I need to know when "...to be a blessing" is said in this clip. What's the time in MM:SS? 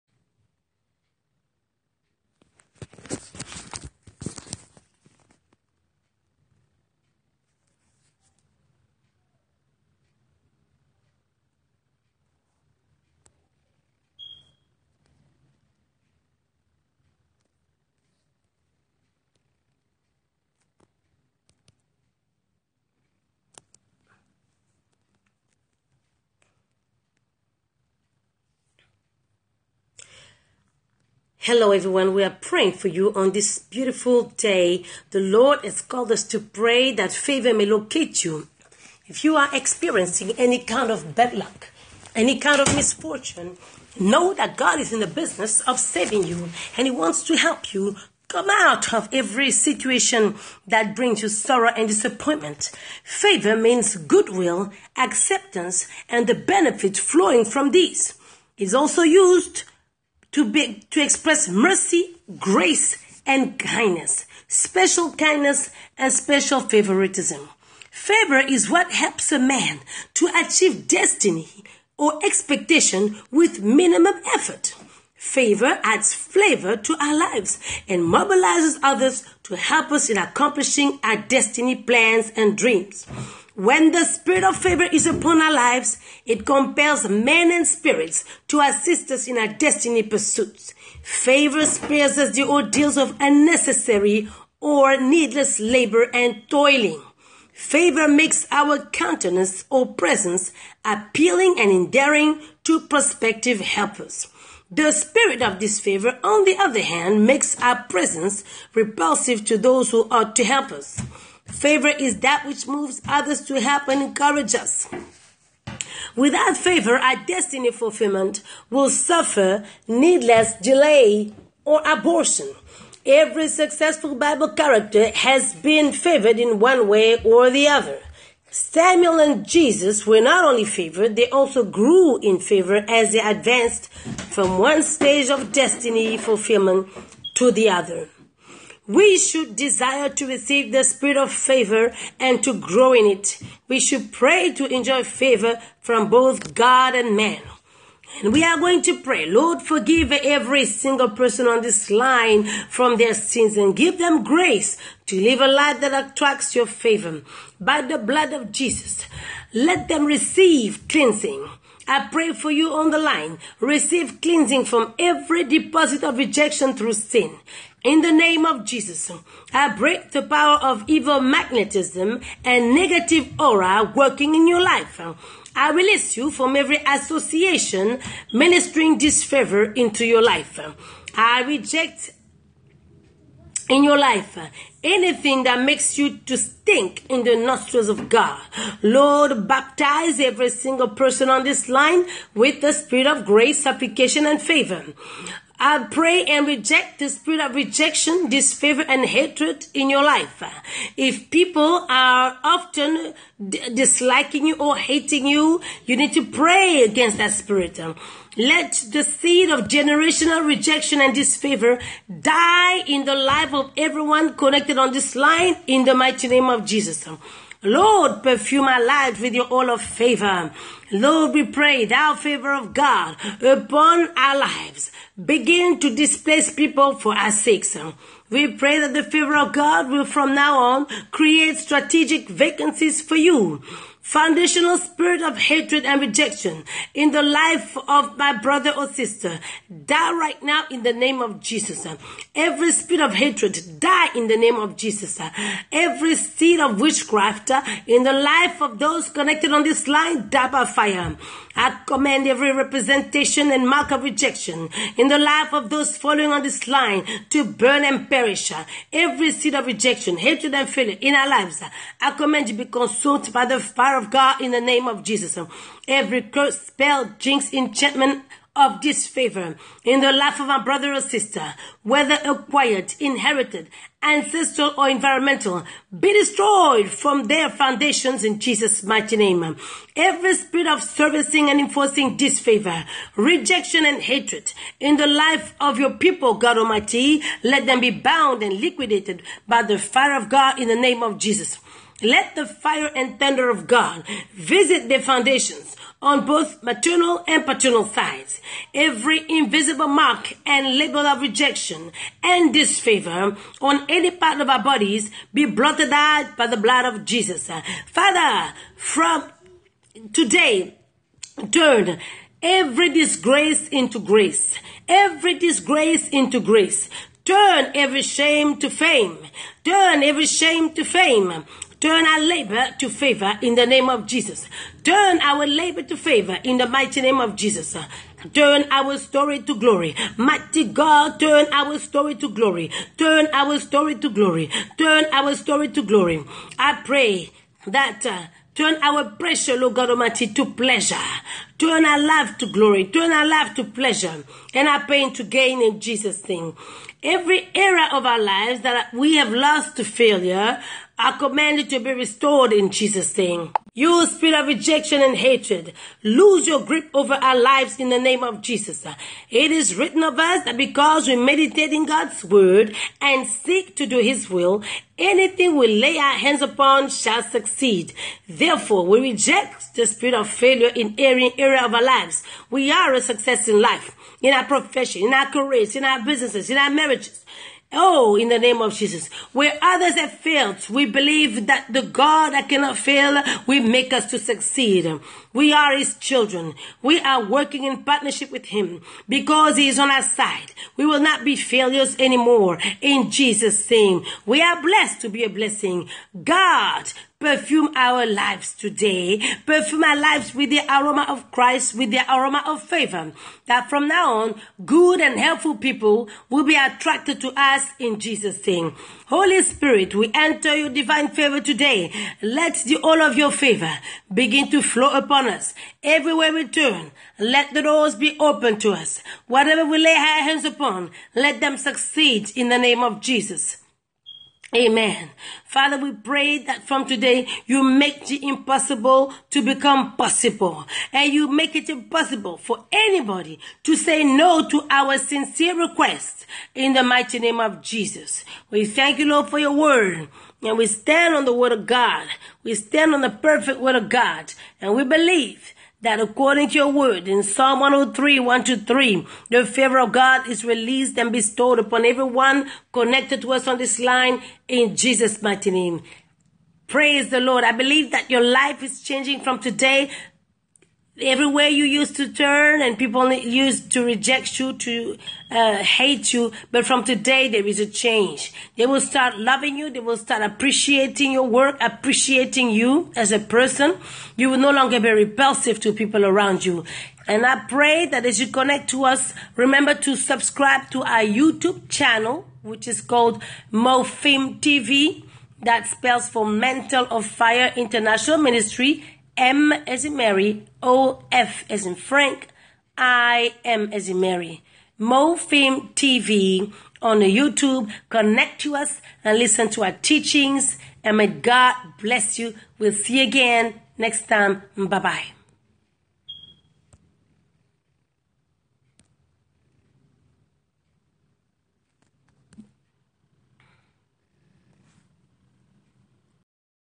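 06:35.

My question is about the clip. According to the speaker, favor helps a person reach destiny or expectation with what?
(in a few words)
Minimum effort.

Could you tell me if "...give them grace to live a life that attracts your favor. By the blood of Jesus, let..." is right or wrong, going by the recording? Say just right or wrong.
right.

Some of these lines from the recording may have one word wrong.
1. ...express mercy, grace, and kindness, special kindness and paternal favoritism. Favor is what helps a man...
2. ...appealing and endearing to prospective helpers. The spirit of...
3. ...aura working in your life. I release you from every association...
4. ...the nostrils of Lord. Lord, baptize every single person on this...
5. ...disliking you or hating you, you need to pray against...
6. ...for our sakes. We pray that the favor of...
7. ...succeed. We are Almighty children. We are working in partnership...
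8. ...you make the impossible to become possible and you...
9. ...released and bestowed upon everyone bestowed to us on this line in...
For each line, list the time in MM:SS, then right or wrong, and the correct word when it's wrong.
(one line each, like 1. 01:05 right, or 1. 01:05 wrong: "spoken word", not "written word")
1. 01:01 wrong: "special", not "paternal"
2. 01:40 right
3. 02:53 right
4. 03:07 wrong: "God", not "Lord"
5. 03:23 right
6. 03:46 right
7. 06:24 wrong: "His", not "Almighty"
8. 07:07 right
9. 07:30 wrong: "connected", not "bestowed".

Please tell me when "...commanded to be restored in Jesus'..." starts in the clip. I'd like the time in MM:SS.
05:51.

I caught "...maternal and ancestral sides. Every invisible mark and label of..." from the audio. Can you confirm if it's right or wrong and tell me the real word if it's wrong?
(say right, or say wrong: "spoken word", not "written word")
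wrong: "paternal", not "ancestral".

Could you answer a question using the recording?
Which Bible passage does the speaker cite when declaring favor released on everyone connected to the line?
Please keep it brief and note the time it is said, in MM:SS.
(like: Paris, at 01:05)
Psalm 103:1-3, at 07:27.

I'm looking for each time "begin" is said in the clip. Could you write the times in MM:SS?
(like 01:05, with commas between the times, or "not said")
03:45, 06:54.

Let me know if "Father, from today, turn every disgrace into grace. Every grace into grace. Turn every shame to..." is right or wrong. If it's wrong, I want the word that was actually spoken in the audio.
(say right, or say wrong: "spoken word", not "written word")
wrong: "disgrace", not "grace".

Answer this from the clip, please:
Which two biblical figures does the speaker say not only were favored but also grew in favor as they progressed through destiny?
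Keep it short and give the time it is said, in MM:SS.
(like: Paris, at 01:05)
Samuel and Jesus, at 02:08.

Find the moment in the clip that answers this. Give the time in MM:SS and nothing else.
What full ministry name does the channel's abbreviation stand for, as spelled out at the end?
08:06.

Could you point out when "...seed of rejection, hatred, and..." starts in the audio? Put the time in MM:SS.
04:19.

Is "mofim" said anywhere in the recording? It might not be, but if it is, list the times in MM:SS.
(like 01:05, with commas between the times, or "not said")
08:03, 08:14.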